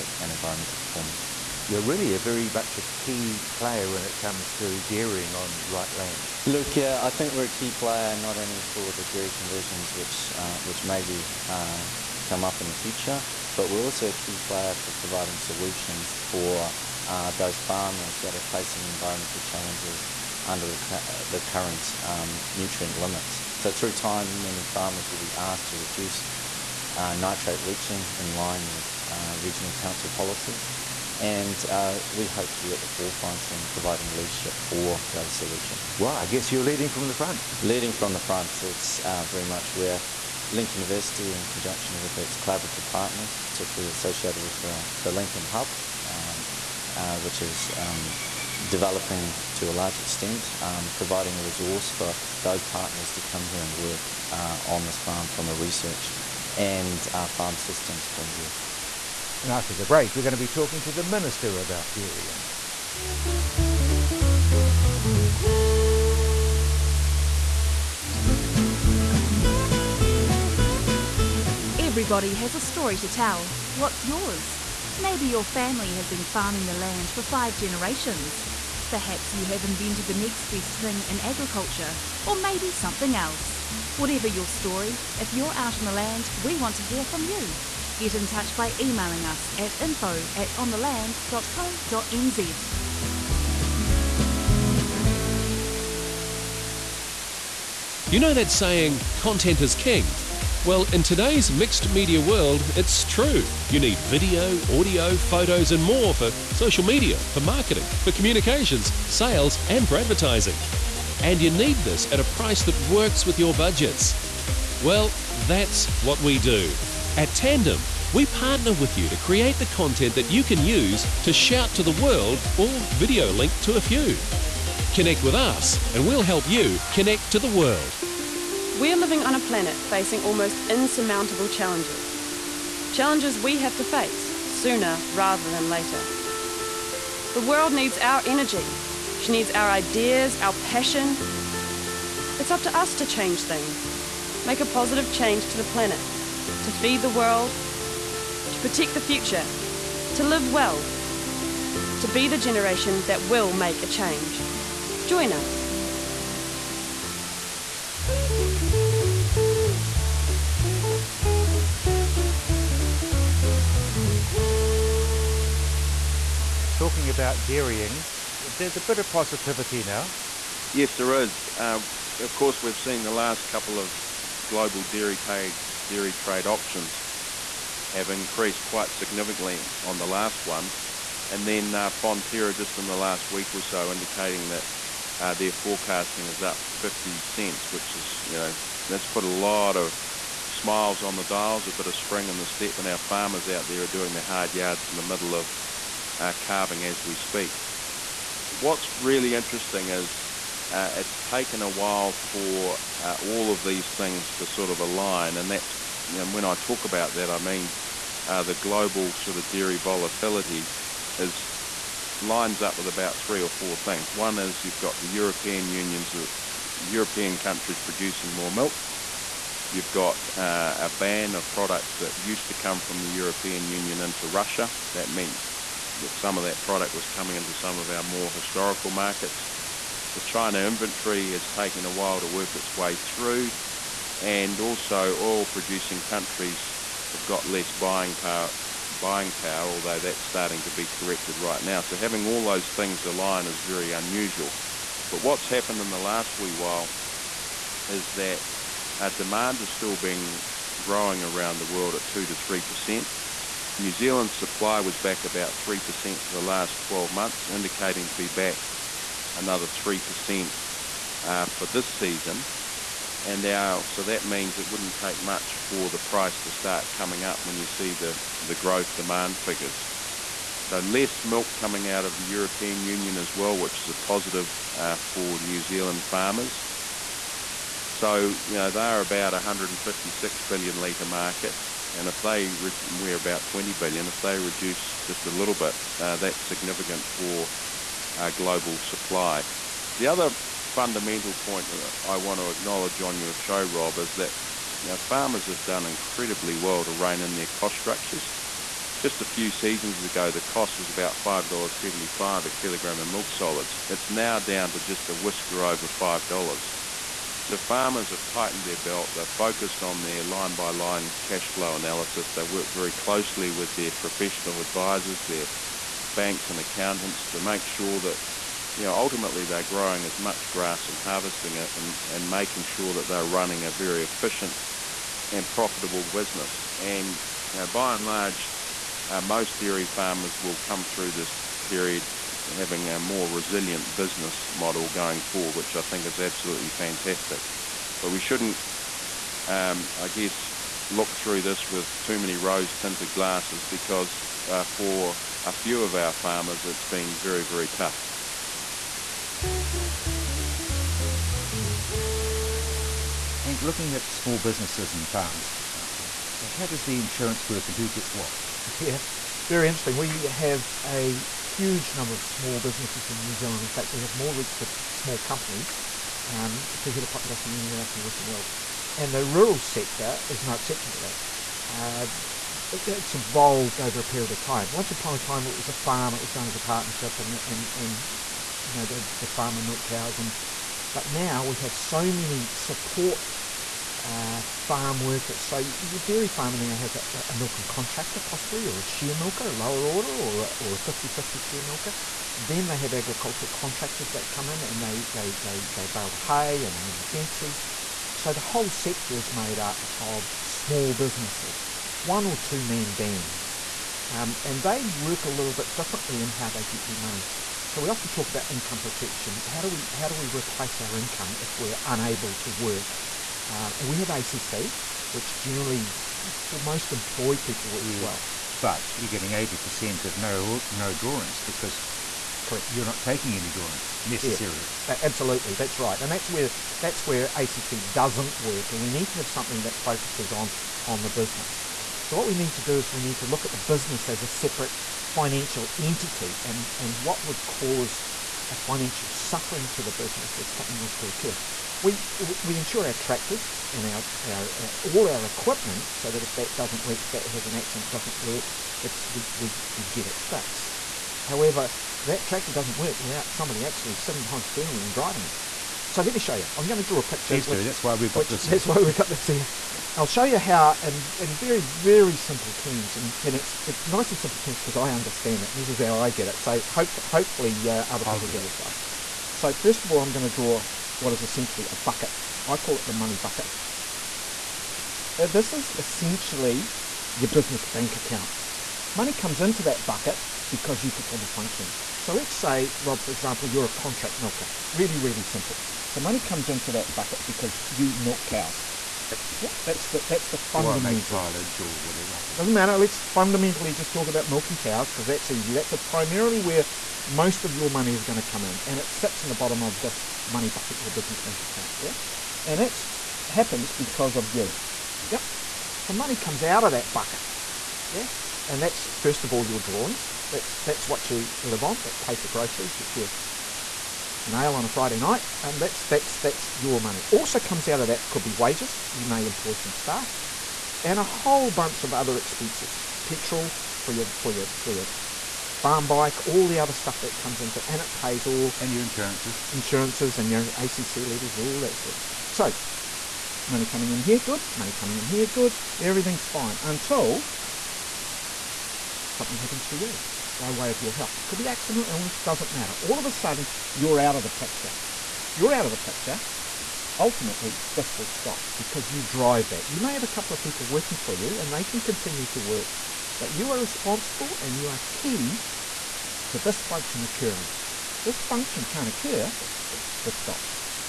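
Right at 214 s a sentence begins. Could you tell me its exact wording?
One is you've got the European unions, the uh, European countries producing more milk.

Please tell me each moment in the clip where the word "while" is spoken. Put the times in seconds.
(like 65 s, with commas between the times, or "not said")
201 s, 231 s, 246 s.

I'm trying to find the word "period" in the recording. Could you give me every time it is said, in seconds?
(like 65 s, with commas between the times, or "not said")
331 s, 374 s.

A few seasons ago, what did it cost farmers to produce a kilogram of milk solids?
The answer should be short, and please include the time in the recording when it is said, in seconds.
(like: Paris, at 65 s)
$5.75, at 301 s.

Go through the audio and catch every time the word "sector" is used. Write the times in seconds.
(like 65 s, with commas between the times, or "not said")
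369 s, 398 s.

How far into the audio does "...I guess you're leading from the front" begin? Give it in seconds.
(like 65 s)
36 s.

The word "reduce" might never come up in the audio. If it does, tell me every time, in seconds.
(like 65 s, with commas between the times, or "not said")
25 s, 284 s.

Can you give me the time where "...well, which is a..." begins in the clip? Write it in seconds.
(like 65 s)
273 s.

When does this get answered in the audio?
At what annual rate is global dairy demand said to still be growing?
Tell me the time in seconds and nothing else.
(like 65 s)
252 s.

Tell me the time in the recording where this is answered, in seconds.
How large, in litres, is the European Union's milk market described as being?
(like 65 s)
279 s.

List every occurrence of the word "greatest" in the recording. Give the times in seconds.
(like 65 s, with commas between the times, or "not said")
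not said.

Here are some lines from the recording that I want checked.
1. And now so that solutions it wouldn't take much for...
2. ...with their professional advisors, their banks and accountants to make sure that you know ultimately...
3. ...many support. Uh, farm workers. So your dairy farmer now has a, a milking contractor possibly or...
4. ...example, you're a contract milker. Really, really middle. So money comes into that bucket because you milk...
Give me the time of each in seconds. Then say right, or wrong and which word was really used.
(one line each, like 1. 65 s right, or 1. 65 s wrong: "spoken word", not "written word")
1. 263 s wrong: "means", not "solutions"
2. 313 s right
3. 382 s right
4. 483 s wrong: "simple", not "middle".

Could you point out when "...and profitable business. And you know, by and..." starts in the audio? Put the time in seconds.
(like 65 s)
325 s.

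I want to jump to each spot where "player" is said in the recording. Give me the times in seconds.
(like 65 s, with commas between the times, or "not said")
3 s, 7 s, 14 s.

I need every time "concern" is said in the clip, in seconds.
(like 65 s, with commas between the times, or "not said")
not said.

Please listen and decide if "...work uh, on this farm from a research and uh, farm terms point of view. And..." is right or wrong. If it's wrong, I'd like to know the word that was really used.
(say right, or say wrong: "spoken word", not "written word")
wrong: "systems", not "terms".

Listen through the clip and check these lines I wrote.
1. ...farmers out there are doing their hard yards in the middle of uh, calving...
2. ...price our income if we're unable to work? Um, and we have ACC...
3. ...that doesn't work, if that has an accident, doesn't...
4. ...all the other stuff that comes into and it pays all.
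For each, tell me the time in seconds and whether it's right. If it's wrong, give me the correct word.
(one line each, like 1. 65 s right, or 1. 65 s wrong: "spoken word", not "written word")
1. 193 s right
2. 410 s wrong: "replace", not "price"
3. 446 s right
4. 526 s right.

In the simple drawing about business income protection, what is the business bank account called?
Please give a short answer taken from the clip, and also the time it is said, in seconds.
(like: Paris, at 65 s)
the money bucket, at 472 s.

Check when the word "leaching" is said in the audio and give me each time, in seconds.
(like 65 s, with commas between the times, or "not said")
27 s.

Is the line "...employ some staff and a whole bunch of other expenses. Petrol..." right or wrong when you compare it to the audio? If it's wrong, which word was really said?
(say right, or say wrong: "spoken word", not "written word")
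right.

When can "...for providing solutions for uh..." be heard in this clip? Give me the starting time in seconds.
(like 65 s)
14 s.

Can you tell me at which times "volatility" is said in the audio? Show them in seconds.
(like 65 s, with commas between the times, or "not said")
209 s.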